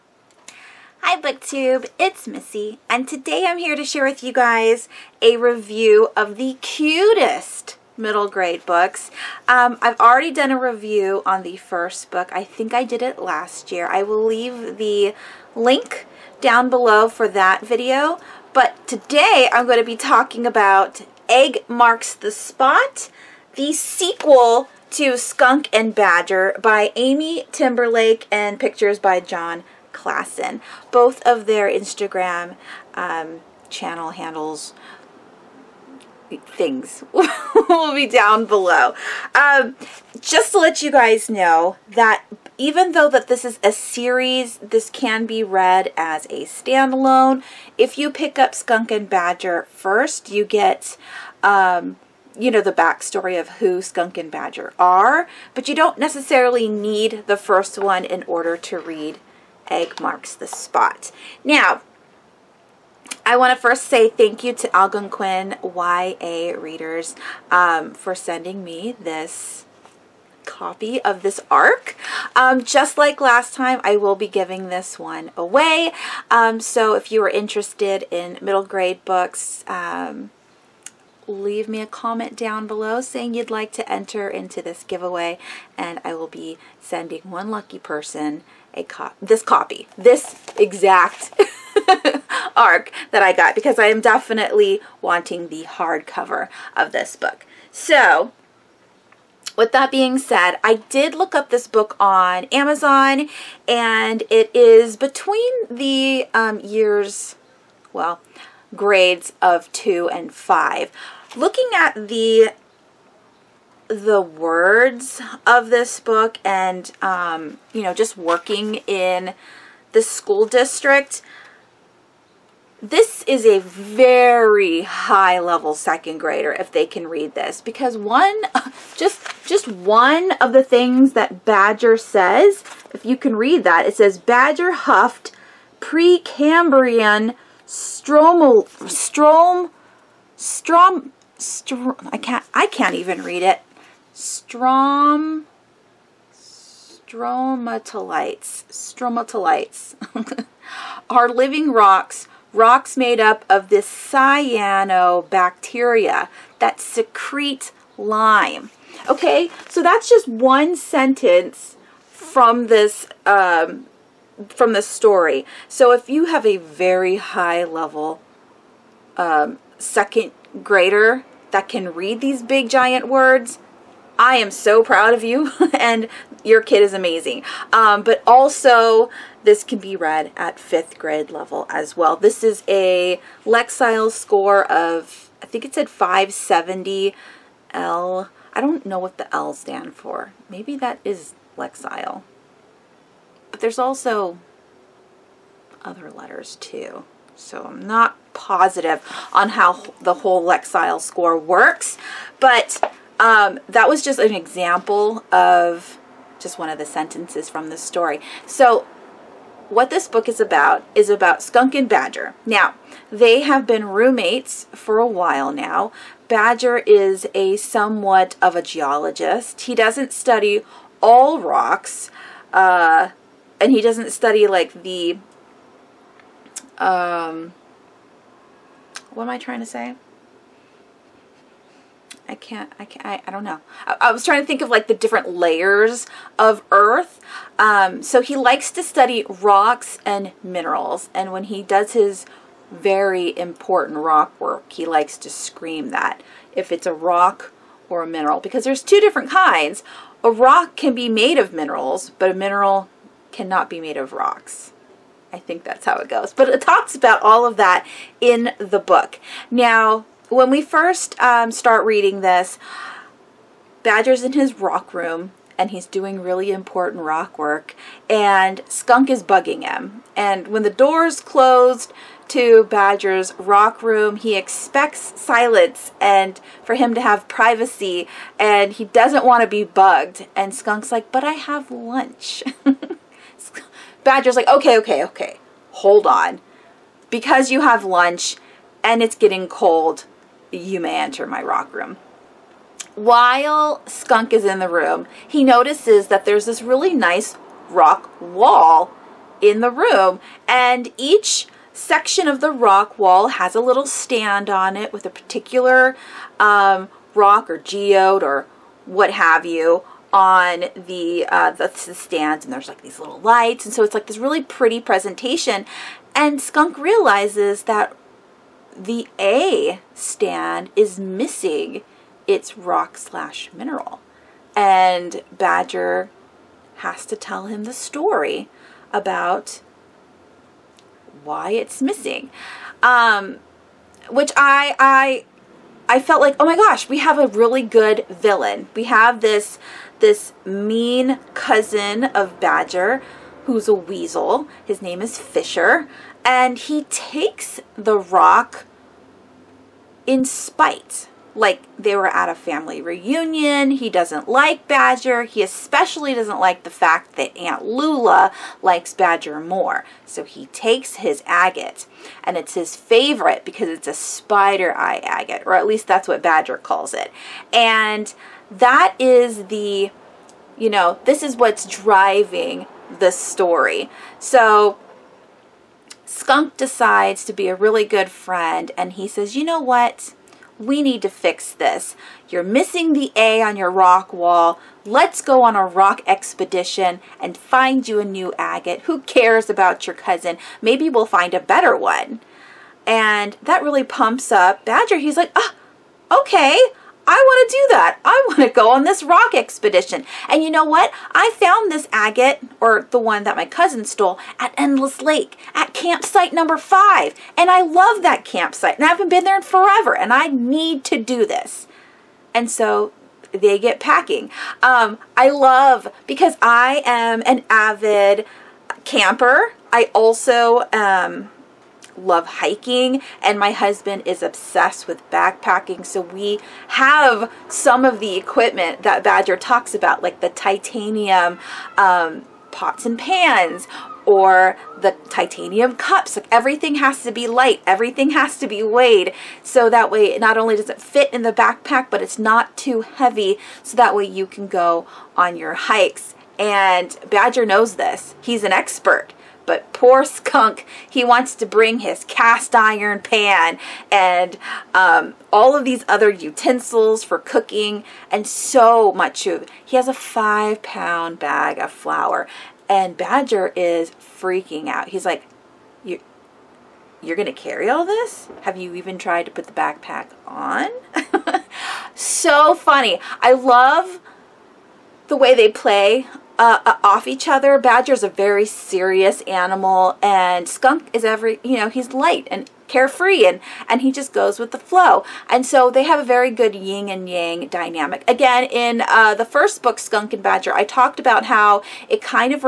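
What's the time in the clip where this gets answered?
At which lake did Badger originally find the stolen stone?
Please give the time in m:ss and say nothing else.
6:44.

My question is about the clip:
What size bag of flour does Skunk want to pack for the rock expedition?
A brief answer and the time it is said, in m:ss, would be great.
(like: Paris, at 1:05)
5 pound, at 7:39.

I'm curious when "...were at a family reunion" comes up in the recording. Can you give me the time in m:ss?
5:51.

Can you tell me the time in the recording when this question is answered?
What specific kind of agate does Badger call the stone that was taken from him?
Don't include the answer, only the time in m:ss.
6:03.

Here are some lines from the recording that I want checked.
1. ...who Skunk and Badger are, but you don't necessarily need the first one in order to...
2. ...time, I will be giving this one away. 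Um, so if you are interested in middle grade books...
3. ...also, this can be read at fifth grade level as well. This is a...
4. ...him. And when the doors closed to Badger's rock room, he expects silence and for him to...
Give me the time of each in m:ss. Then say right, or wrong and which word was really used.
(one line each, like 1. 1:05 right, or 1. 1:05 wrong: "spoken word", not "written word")
1. 0:53 right
2. 1:13 right
3. 2:58 right
4. 4:29 right.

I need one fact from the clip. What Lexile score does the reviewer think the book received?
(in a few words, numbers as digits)
570 L.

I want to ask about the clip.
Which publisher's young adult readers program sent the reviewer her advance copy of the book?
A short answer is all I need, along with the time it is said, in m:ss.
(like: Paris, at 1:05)
Algonquin, at 1:04.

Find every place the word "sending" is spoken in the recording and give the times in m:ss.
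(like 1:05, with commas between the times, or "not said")
1:08, 1:26.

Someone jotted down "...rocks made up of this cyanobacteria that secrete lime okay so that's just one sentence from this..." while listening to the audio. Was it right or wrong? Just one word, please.
right.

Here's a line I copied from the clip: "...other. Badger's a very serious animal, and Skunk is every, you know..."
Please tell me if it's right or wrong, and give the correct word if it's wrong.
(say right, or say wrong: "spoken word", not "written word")
right.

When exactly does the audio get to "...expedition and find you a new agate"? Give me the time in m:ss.
6:26.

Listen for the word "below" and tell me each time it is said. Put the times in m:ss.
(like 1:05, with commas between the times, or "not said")
0:16, 0:38, 1:22.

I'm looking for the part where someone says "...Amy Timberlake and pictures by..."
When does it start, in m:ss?
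0:26.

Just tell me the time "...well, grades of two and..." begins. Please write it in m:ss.
1:47.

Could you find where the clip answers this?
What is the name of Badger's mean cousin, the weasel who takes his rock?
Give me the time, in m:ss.
5:45.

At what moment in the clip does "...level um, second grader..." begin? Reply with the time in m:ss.
2:47.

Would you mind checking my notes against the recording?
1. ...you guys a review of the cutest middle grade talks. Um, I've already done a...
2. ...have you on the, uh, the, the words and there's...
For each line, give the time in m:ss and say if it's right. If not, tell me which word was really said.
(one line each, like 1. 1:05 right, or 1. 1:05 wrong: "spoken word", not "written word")
1. 0:04 wrong: "books", not "talks"
2. 5:09 wrong: "stands", not "words".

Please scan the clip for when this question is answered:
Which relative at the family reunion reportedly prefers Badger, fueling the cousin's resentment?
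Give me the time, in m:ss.
5:57.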